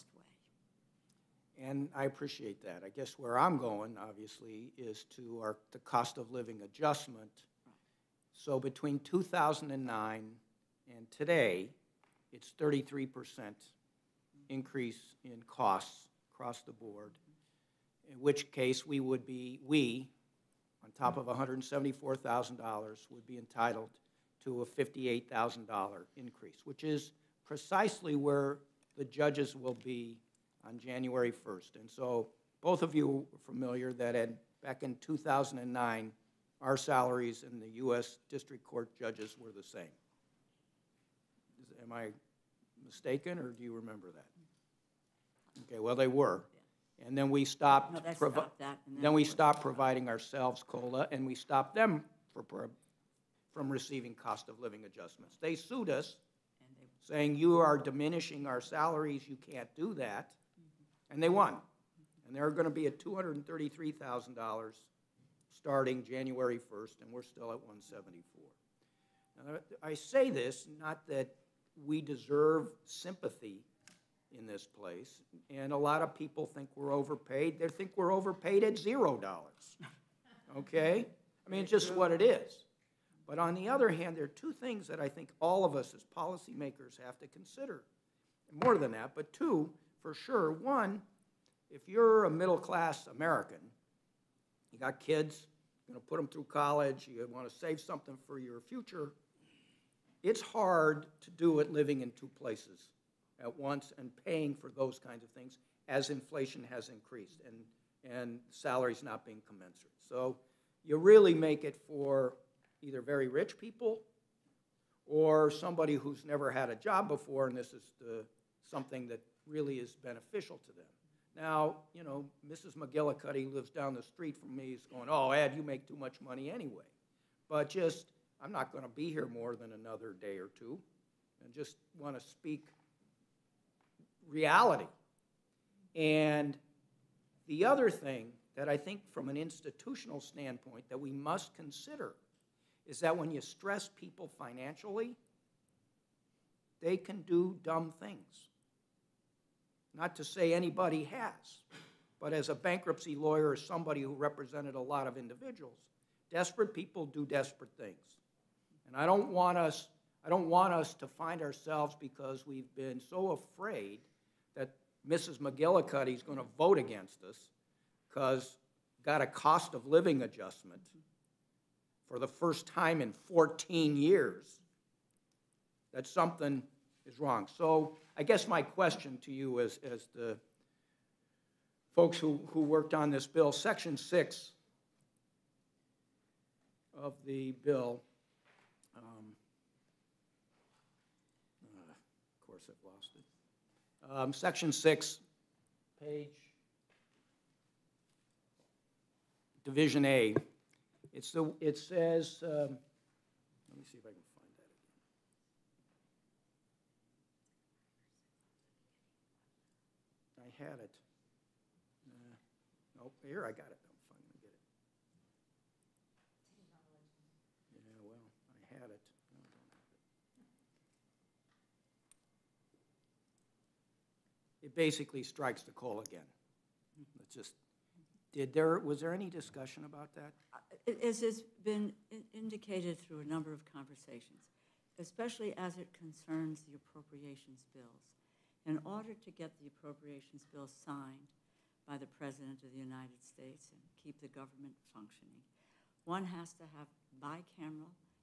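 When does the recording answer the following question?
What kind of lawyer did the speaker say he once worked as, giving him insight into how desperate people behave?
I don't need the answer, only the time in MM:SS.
02:32.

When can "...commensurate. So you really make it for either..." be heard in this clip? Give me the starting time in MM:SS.
01:49.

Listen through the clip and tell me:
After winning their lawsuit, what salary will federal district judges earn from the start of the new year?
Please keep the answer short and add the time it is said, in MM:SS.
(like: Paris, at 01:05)
$233,000, at 01:02.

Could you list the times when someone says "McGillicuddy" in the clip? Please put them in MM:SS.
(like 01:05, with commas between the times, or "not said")
02:02, 02:45.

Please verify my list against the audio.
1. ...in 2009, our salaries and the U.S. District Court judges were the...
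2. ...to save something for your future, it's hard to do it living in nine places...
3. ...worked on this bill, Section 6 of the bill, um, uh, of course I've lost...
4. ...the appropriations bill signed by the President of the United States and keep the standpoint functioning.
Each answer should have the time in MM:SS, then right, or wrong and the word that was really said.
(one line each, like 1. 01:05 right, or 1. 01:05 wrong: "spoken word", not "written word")
1. 00:34 right
2. 01:37 wrong: "two", not "nine"
3. 03:02 right
4. 03:59 wrong: "government", not "standpoint".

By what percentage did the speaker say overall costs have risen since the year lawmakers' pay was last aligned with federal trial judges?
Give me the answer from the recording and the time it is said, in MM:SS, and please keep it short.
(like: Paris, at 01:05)
33%, at 00:12.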